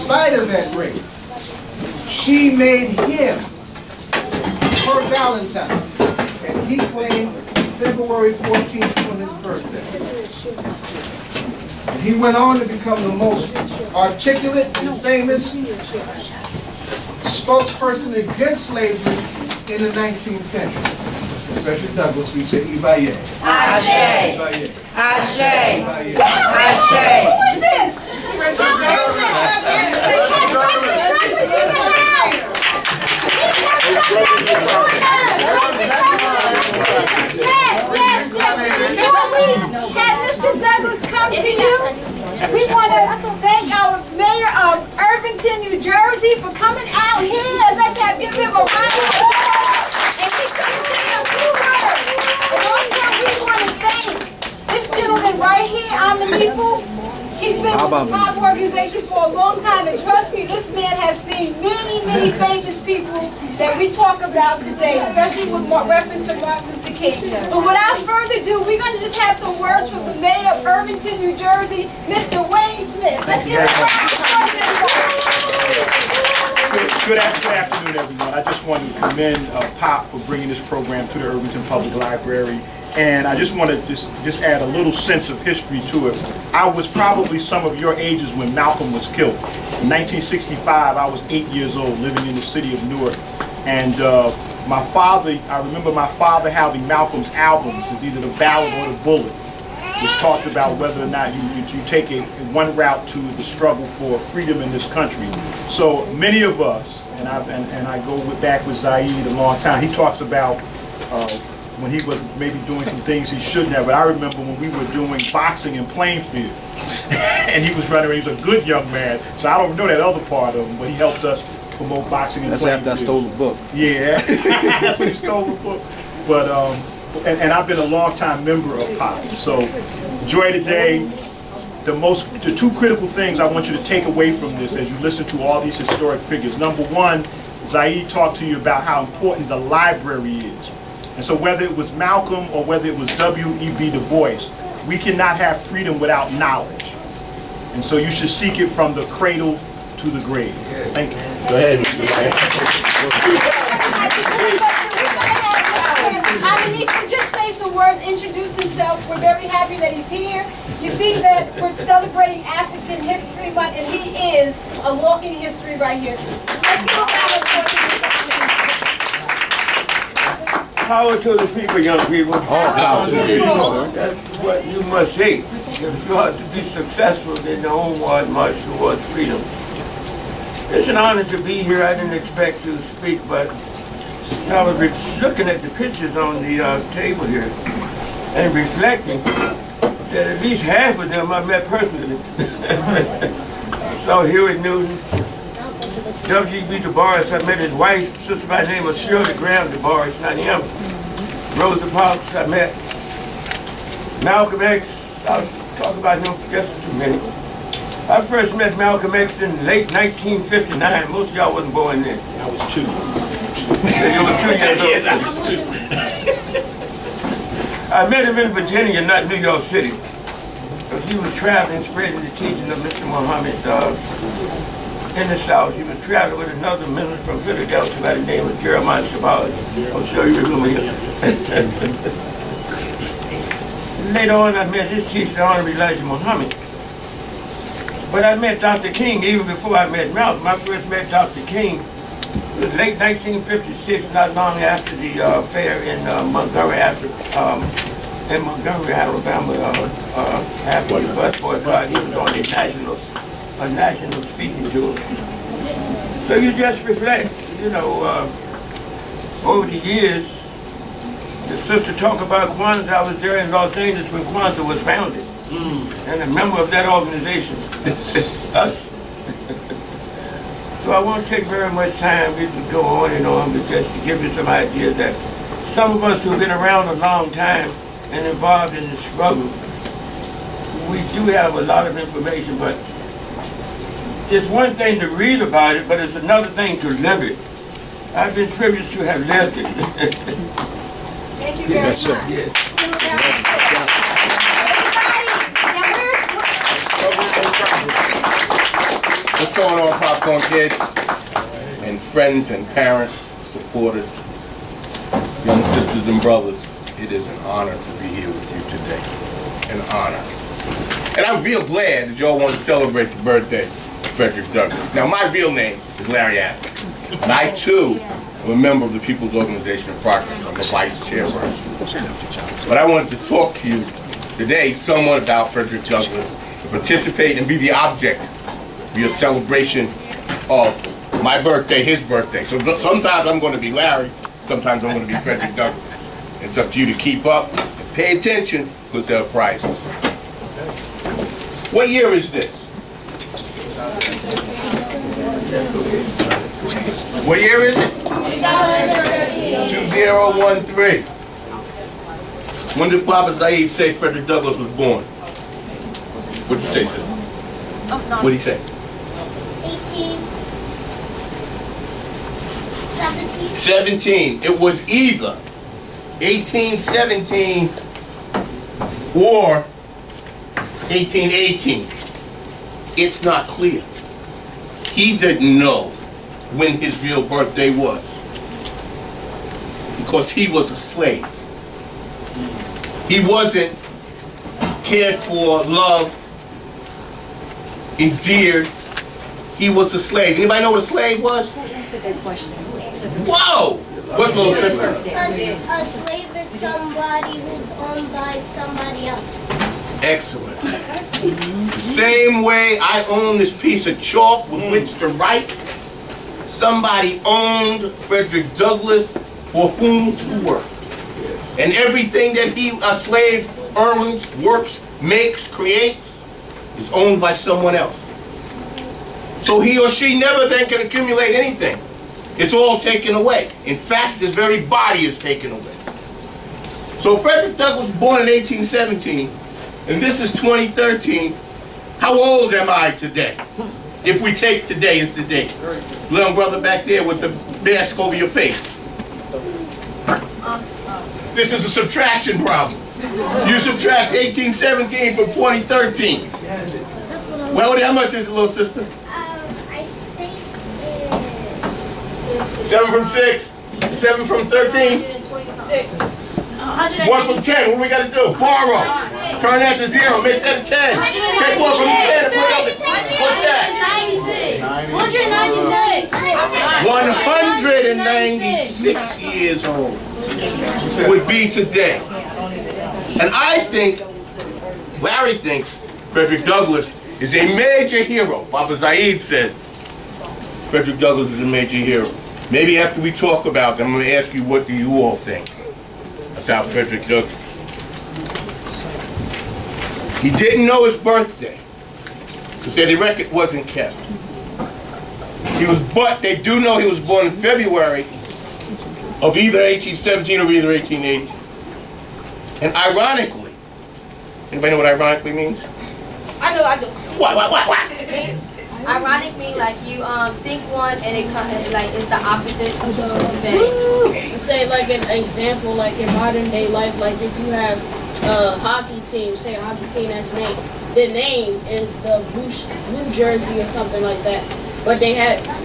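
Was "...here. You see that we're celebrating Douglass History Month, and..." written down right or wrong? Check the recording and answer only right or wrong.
wrong.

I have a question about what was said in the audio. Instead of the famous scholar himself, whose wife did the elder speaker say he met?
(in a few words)
Shirley Graham Du Bois.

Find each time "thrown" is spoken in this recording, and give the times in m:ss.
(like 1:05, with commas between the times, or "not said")
not said.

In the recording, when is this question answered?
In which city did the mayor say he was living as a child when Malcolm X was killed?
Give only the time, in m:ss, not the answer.
1:32.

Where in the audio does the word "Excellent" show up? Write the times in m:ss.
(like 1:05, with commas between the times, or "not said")
6:40.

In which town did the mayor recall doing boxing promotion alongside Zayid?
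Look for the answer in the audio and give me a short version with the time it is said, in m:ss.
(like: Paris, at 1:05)
Plainfield, at 1:55.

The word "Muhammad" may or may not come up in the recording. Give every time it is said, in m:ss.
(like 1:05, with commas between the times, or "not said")
3:43, 3:56.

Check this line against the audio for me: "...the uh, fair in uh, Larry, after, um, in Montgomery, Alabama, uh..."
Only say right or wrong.
wrong.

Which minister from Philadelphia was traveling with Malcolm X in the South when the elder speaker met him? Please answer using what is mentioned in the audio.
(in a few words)
Jeremiah Shabazz.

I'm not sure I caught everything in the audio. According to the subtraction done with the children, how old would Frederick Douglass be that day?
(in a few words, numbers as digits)
196.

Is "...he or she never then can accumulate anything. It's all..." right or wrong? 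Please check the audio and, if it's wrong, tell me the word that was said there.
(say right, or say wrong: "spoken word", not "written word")
right.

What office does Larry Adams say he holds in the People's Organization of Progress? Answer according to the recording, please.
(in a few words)
Vice chairperson.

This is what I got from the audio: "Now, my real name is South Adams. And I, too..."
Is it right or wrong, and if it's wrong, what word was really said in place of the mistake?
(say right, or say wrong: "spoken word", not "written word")
wrong: "Larry", not "South".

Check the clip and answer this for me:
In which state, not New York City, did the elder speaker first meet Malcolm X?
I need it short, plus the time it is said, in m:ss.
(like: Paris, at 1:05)
Virginia, at 3:38.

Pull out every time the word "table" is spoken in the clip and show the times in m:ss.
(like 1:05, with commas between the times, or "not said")
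3:06.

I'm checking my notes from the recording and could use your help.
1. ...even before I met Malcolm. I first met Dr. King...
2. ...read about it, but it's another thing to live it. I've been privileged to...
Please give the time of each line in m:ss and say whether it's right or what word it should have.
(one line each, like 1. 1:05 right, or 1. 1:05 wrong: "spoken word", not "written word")
1. 3:59 right
2. 4:45 right.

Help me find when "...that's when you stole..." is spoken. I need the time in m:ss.
2:04.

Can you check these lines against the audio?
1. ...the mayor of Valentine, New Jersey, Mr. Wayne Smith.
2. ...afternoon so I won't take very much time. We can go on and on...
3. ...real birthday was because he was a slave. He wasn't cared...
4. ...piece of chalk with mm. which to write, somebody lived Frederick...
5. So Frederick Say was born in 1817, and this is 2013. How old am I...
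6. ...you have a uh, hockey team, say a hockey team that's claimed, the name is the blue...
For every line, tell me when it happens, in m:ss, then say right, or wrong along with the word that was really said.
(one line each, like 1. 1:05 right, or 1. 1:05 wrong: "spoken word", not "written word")
1. 1:10 wrong: "Irvington", not "Valentine"
2. 4:26 wrong: "organization", not "afternoon"
3. 6:17 right
4. 6:43 wrong: "owned", not "lived"
5. 7:06 wrong: "Douglass", not "Say"
6. 8:37 wrong: "named", not "claimed".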